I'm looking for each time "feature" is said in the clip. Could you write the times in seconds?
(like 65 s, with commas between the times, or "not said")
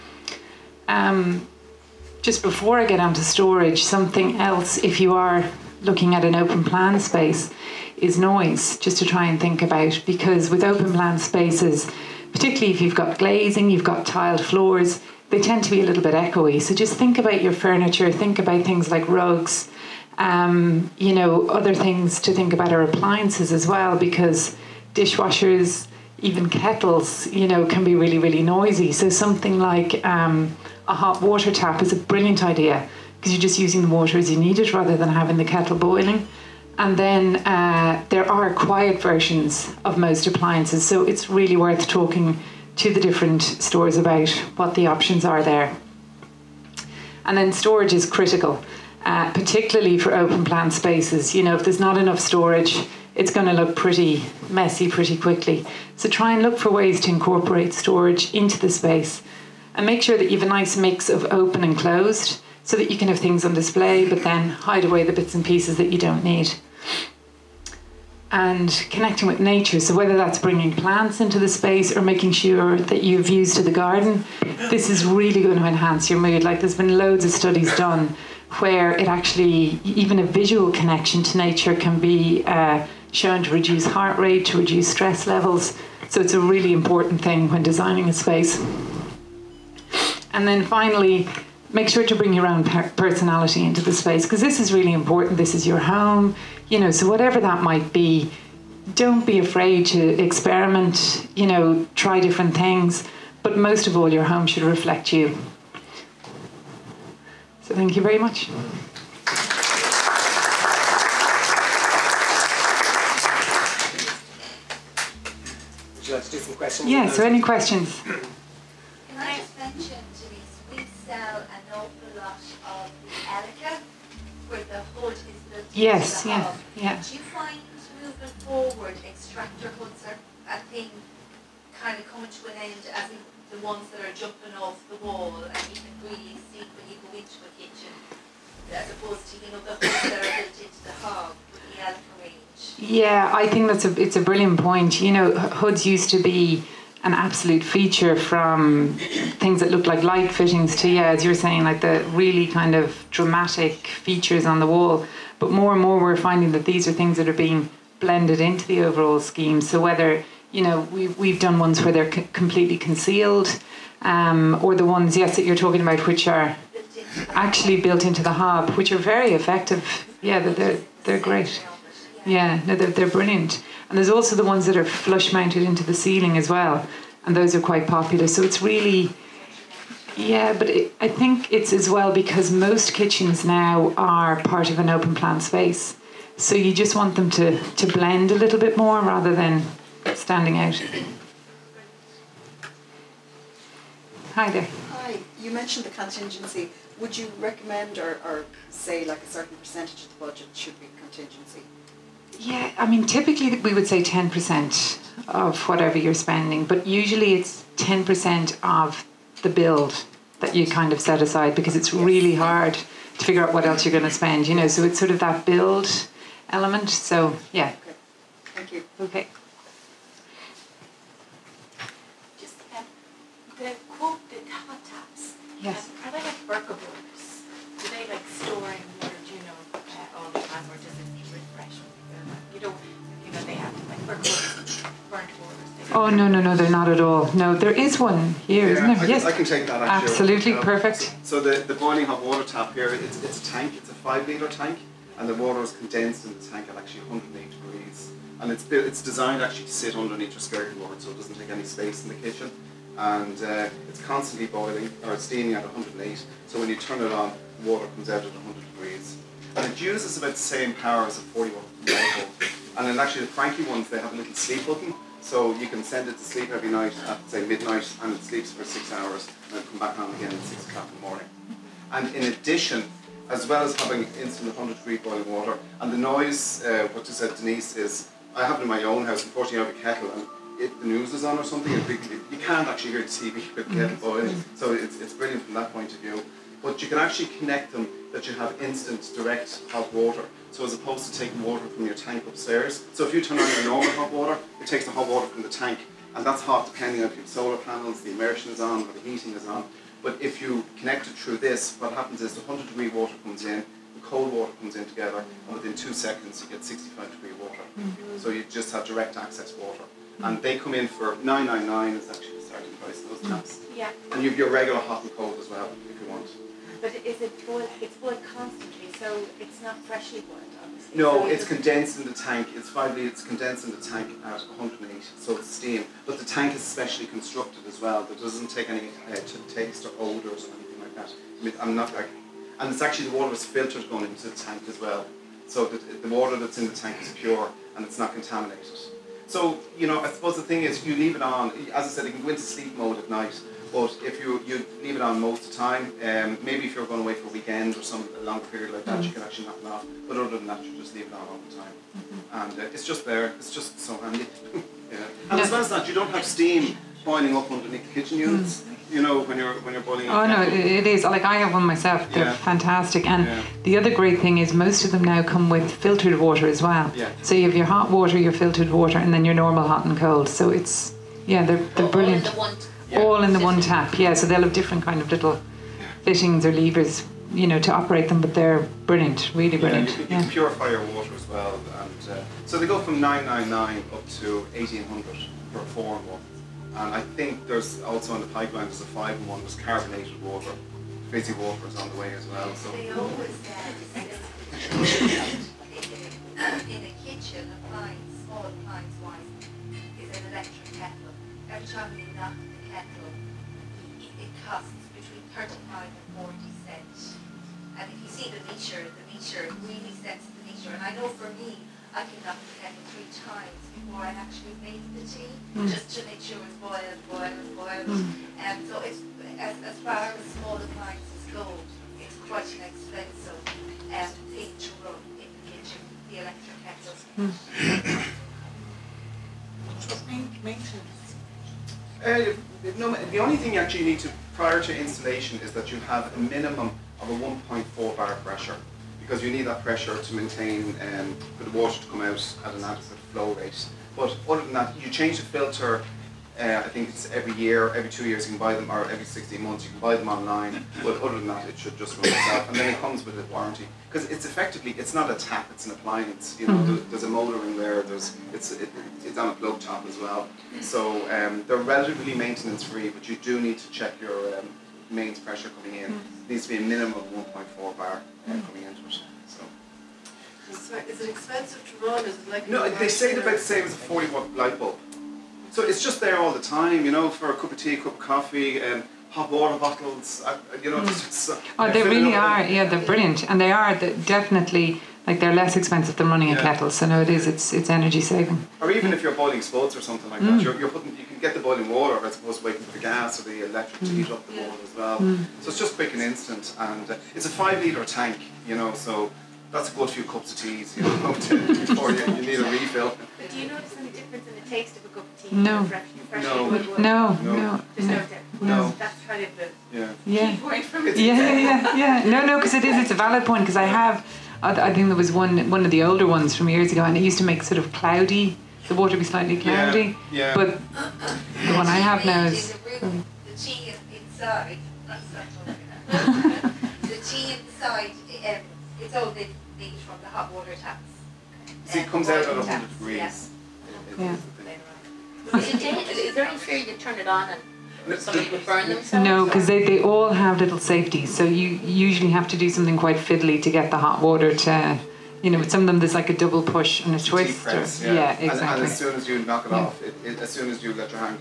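147 s, 153 s.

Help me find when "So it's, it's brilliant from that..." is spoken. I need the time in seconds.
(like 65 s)
284 s.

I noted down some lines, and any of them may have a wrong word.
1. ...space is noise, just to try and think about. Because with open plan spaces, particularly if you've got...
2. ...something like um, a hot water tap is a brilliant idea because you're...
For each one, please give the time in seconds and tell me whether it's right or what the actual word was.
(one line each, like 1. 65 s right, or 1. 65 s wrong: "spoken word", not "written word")
1. 6 s right
2. 29 s right.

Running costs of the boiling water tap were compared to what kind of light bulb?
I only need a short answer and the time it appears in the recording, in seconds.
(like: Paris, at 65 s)
40 watt, at 473 s.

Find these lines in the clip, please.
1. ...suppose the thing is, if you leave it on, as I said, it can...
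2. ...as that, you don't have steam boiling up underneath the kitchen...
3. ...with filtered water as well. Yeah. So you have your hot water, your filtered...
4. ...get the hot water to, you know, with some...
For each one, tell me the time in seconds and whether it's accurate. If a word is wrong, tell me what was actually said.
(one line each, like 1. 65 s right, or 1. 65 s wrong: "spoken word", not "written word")
1. 340 s right
2. 355 s right
3. 365 s right
4. 543 s right.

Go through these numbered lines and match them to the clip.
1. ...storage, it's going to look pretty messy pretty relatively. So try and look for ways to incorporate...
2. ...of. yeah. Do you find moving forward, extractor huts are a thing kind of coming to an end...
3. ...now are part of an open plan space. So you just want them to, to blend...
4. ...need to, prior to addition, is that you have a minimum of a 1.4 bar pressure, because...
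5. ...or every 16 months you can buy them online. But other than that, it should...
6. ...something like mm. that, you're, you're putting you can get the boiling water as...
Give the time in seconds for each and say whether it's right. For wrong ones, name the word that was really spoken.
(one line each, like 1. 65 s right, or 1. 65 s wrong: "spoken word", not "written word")
1. 52 s wrong: "quickly", not "relatively"
2. 126 s right
3. 183 s right
4. 433 s wrong: "installation", not "addition"
5. 448 s right
6. 489 s right.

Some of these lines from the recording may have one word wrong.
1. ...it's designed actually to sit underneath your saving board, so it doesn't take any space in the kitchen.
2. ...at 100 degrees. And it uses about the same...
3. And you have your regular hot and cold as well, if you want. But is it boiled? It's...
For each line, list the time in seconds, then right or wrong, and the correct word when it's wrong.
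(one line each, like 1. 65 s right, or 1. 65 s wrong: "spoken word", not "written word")
1. 248 s wrong: "skirting", not "saving"
2. 258 s right
3. 314 s right.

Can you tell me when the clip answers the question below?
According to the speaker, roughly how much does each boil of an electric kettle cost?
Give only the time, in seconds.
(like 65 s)
404 s.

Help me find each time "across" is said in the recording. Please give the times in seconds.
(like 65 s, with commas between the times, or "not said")
not said.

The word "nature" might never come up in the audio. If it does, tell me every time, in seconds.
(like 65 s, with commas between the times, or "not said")
69 s, 81 s.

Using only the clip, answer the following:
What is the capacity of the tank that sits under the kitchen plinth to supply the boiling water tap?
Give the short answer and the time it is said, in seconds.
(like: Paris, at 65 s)
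5 litres, at 243 s.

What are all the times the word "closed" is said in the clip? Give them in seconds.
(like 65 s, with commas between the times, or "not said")
61 s.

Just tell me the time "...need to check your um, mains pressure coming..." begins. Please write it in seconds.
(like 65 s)
463 s.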